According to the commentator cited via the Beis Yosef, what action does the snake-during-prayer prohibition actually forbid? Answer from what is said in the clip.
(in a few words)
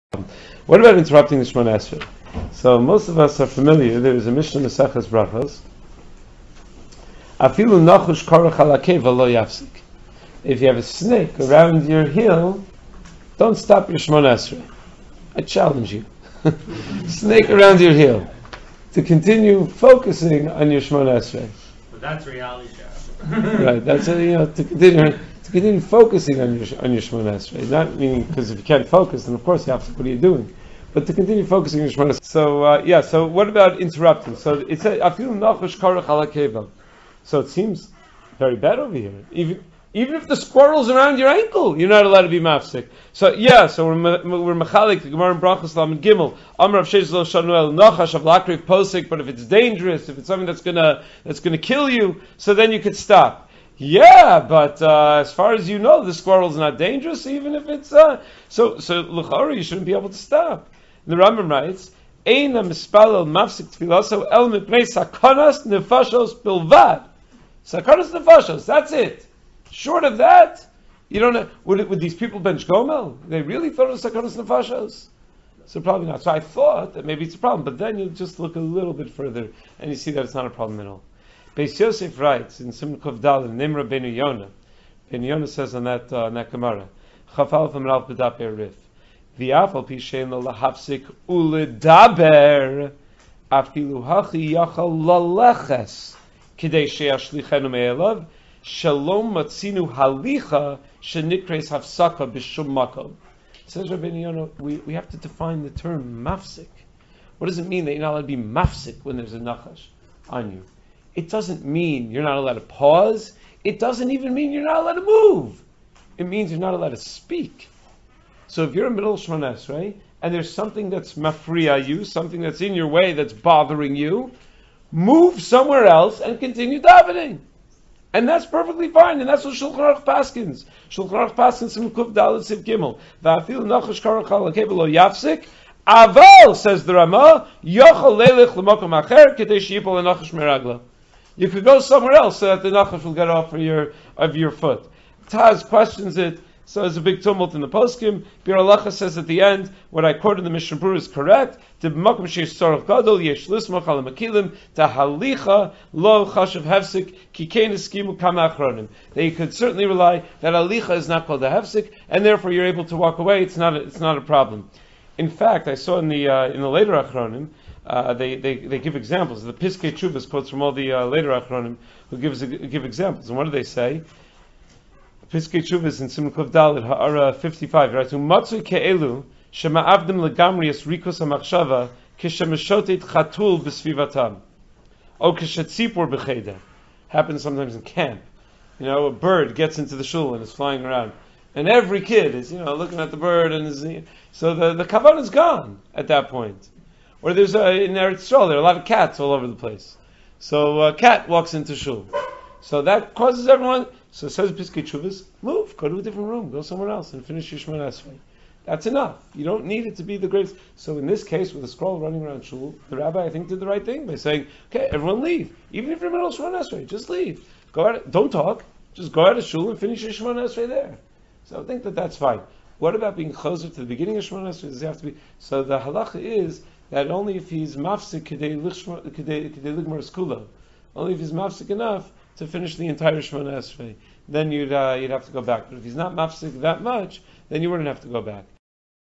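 Speak.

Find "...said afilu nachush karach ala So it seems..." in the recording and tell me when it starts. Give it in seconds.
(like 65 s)
34 s.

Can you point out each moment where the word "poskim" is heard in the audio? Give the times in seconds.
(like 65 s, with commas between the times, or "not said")
147 s.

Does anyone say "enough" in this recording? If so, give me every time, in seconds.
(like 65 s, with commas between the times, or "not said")
208 s, 231 s.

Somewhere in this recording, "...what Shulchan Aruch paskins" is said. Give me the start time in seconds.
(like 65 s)
129 s.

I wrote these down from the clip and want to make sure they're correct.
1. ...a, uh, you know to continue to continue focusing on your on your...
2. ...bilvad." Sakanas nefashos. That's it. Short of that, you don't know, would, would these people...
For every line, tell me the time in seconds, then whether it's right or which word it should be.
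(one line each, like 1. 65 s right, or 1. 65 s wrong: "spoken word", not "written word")
1. 24 s right
2. 66 s right.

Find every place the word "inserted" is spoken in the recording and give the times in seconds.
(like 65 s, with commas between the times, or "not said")
not said.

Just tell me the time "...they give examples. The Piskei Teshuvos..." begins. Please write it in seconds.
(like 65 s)
168 s.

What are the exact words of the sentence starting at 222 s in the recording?
What about being closer to the beginning of Shemon Esrei?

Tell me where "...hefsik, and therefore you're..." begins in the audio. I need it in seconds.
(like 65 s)
161 s.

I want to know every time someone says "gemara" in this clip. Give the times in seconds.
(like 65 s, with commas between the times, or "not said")
45 s, 86 s.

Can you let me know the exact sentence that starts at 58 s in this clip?
So luchari, you shouldn't be able to stop.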